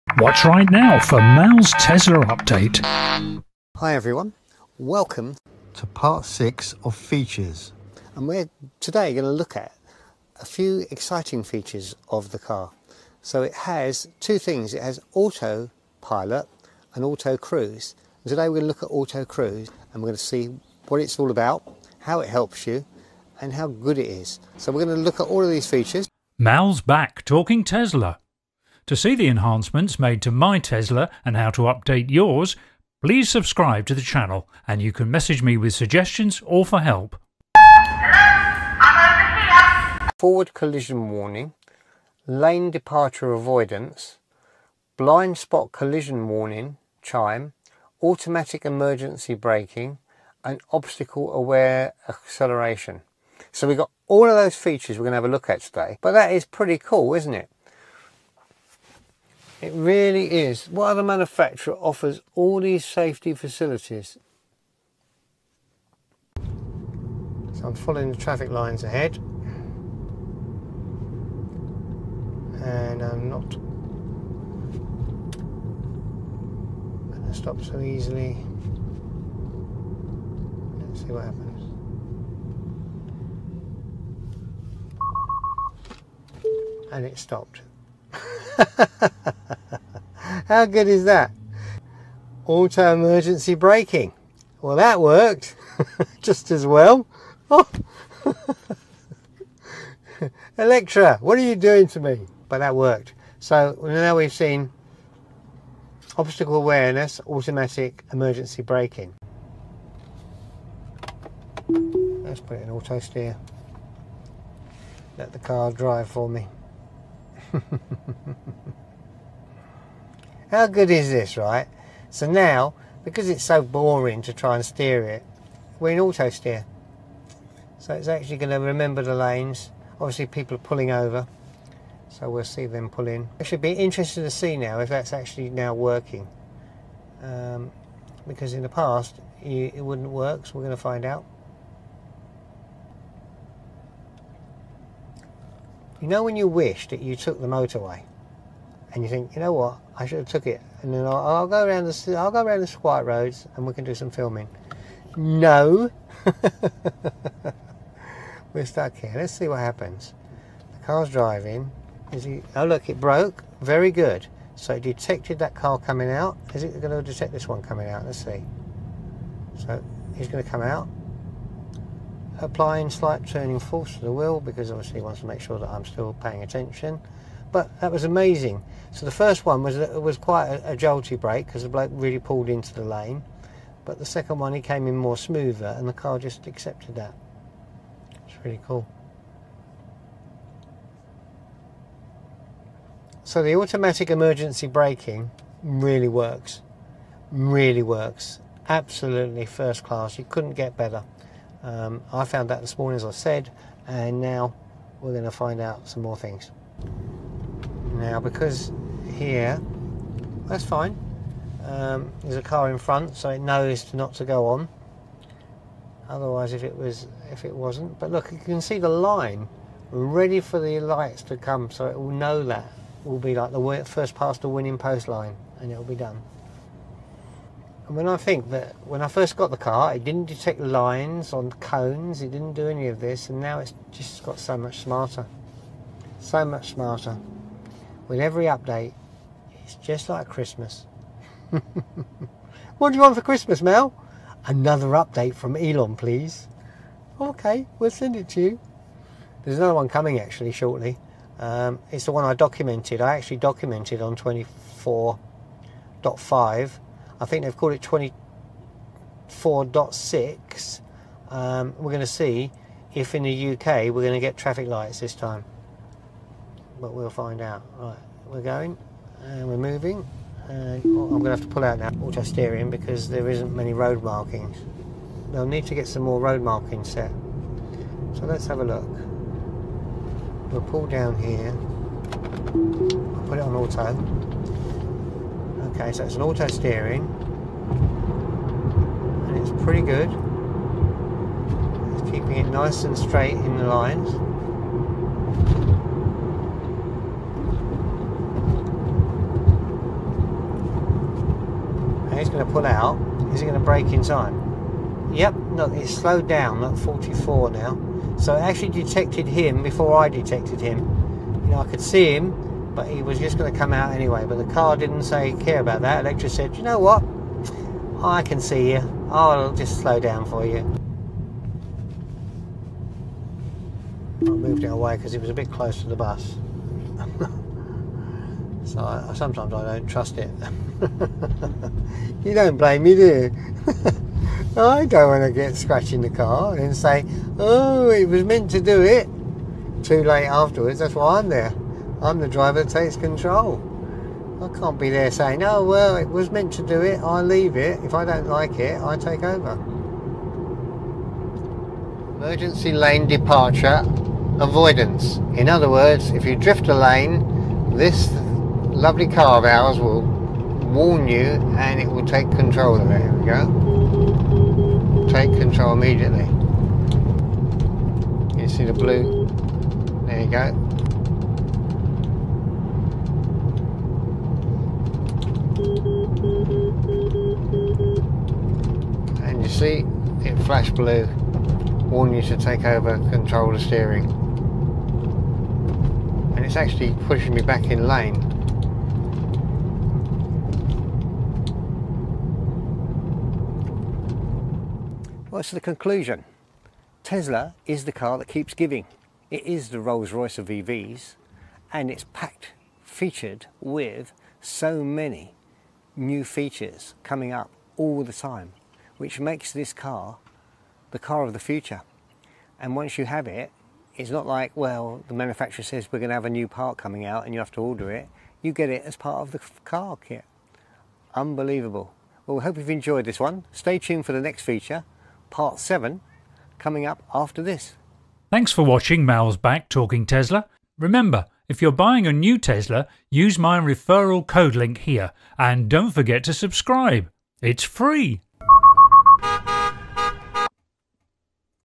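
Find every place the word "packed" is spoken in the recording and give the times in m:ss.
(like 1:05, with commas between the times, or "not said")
6:42.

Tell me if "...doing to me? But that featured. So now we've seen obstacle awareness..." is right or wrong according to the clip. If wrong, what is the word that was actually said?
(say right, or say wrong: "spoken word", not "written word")
wrong: "worked", not "featured".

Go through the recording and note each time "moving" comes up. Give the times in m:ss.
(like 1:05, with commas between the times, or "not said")
4:29.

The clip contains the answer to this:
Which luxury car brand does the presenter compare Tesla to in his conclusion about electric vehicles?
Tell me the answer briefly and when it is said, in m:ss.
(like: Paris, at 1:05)
Rolls-Royce, at 6:39.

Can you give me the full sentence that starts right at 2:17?
Um, because in the past, you, it wouldn't work, so we're going to find out.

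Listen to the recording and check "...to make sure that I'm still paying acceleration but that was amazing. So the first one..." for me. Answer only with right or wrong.
wrong.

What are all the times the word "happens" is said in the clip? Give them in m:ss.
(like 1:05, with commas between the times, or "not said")
1:21, 2:39.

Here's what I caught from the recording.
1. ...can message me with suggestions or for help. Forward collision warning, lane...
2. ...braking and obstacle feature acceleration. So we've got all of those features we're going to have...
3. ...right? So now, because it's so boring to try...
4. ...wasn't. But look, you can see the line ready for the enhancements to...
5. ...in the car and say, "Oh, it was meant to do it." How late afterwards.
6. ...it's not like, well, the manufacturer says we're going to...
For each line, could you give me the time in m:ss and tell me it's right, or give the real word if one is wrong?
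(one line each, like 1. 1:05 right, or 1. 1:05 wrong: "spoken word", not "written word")
1. 0:34 right
2. 0:49 wrong: "aware", not "feature"
3. 2:01 right
4. 3:37 wrong: "lights", not "enhancements"
5. 5:35 wrong: "Too", not "How"
6. 6:53 right.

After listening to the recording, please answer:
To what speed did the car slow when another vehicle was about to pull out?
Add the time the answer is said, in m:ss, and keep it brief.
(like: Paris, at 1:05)
44, at 5:06.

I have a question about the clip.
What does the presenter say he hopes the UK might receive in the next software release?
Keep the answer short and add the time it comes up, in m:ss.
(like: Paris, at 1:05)
Traffic lights, at 4:24.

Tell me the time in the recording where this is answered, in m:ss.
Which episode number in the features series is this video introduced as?
0:06.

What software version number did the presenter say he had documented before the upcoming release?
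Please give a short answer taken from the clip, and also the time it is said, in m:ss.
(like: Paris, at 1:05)
24.5, at 4:14.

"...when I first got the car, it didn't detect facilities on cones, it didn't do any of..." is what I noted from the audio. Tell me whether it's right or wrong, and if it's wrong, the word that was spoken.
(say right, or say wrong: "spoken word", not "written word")
wrong: "lines", not "facilities".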